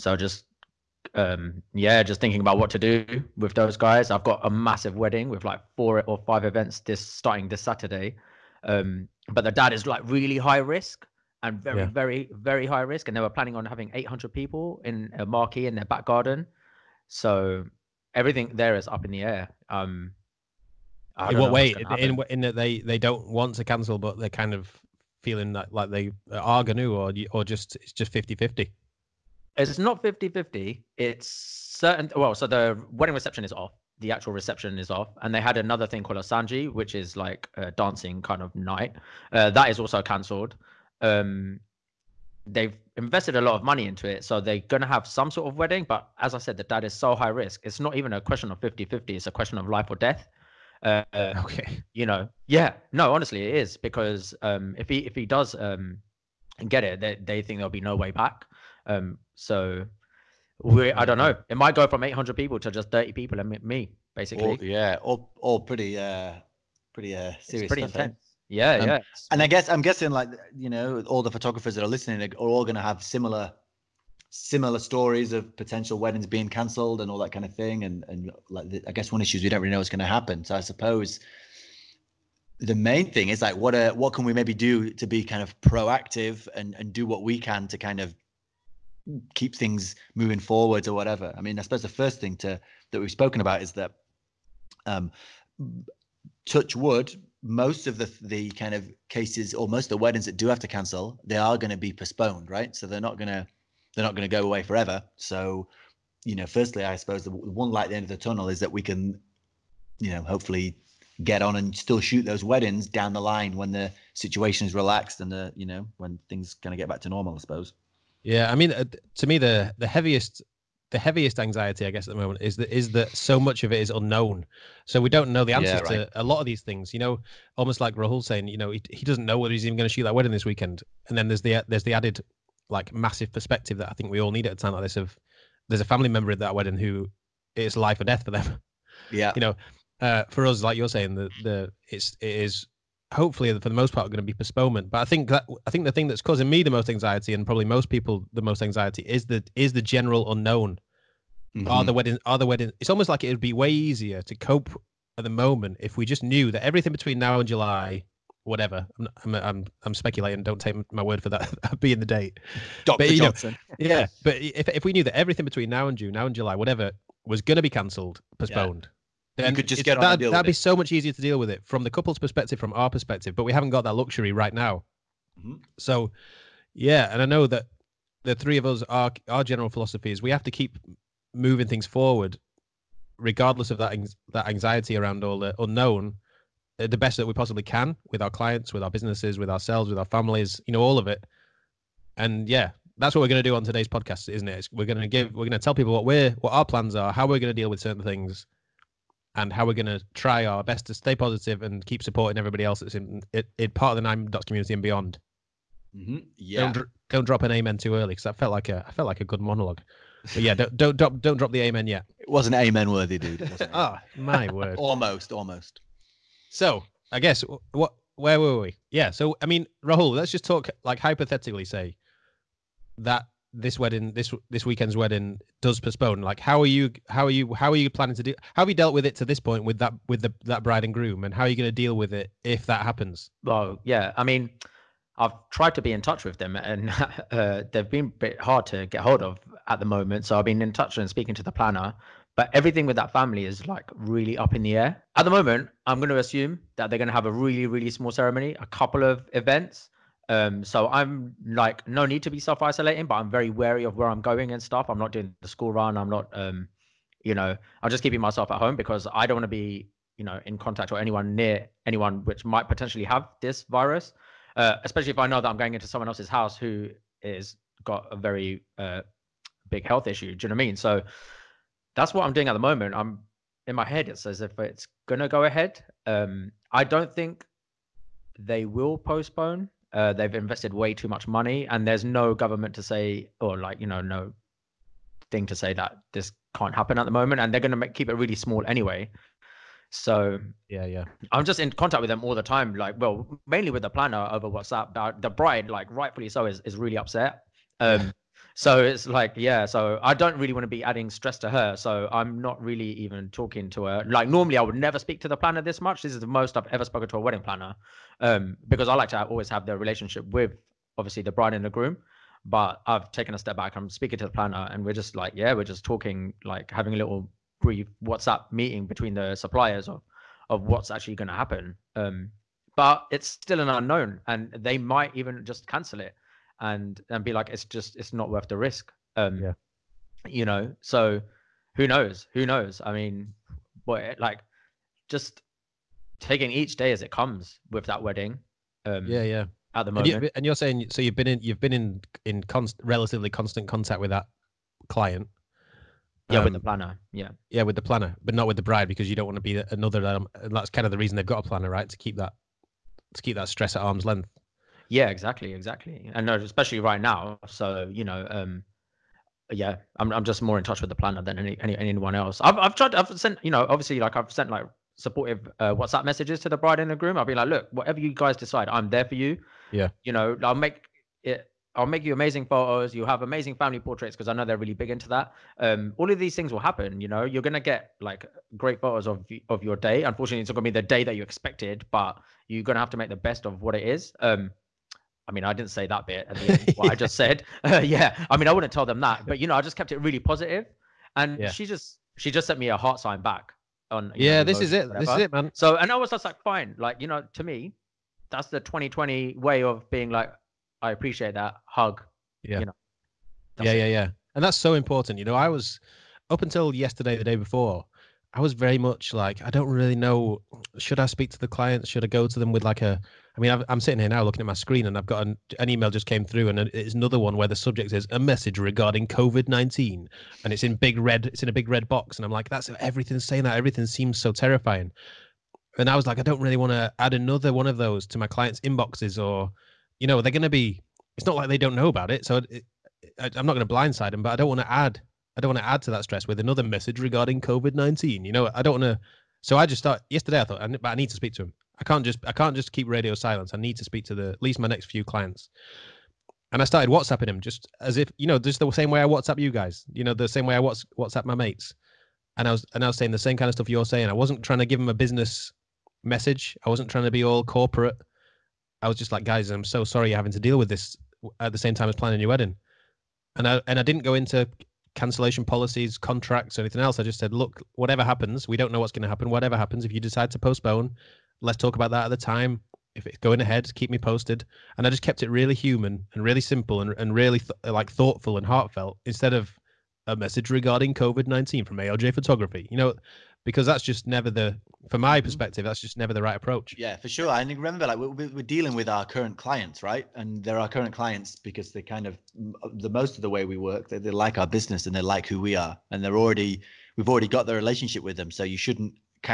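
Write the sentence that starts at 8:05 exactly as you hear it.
perspective, that's just never the right approach.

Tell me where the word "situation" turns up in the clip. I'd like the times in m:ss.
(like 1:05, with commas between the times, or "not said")
1:54.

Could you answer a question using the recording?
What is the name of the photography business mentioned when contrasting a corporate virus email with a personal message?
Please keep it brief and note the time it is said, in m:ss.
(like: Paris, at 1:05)
ALJ Photography, at 8:01.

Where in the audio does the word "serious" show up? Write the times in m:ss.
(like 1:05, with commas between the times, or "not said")
1:07.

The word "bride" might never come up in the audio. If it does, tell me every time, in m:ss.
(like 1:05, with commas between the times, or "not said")
3:50, 4:55, 5:11, 5:48, 6:06.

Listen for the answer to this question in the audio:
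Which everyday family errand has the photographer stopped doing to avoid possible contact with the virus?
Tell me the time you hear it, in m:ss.
4:15.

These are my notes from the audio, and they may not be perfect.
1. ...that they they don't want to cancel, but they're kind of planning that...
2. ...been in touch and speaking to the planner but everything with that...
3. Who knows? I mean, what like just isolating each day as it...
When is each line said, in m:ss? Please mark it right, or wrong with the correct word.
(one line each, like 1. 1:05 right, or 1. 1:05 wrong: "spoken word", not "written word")
1. 0:22 wrong: "feeling", not "planning"
2. 4:00 right
3. 5:32 wrong: "taking", not "isolating".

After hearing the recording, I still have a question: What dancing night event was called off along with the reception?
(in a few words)
sanji.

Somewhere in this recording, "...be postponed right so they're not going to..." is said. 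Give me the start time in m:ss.
1:41.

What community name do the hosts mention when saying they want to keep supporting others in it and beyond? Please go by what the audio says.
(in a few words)
Nine Dots.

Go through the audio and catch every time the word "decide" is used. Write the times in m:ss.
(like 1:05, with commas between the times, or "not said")
6:08, 7:50.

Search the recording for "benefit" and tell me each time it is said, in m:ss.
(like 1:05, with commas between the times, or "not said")
not said.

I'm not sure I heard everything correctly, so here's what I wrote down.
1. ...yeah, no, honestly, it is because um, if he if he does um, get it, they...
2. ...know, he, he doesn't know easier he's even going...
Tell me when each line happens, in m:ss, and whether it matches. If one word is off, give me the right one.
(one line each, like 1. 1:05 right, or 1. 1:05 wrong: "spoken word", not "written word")
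1. 0:52 right
2. 2:08 wrong: "whether", not "easier".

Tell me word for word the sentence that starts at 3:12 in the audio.
And yeah, that's what we're going to do on today's podcast, isn't it?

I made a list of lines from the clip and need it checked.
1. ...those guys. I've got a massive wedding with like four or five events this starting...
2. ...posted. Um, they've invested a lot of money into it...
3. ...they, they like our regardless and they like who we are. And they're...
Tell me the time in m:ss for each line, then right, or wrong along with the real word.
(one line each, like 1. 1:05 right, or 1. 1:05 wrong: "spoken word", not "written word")
1. 0:03 right
2. 0:40 wrong: "cancelled", not "posted"
3. 8:13 wrong: "business", not "regardless".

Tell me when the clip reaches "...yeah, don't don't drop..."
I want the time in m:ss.
3:30.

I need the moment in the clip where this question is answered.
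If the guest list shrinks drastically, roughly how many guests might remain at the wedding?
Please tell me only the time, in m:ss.
1:02.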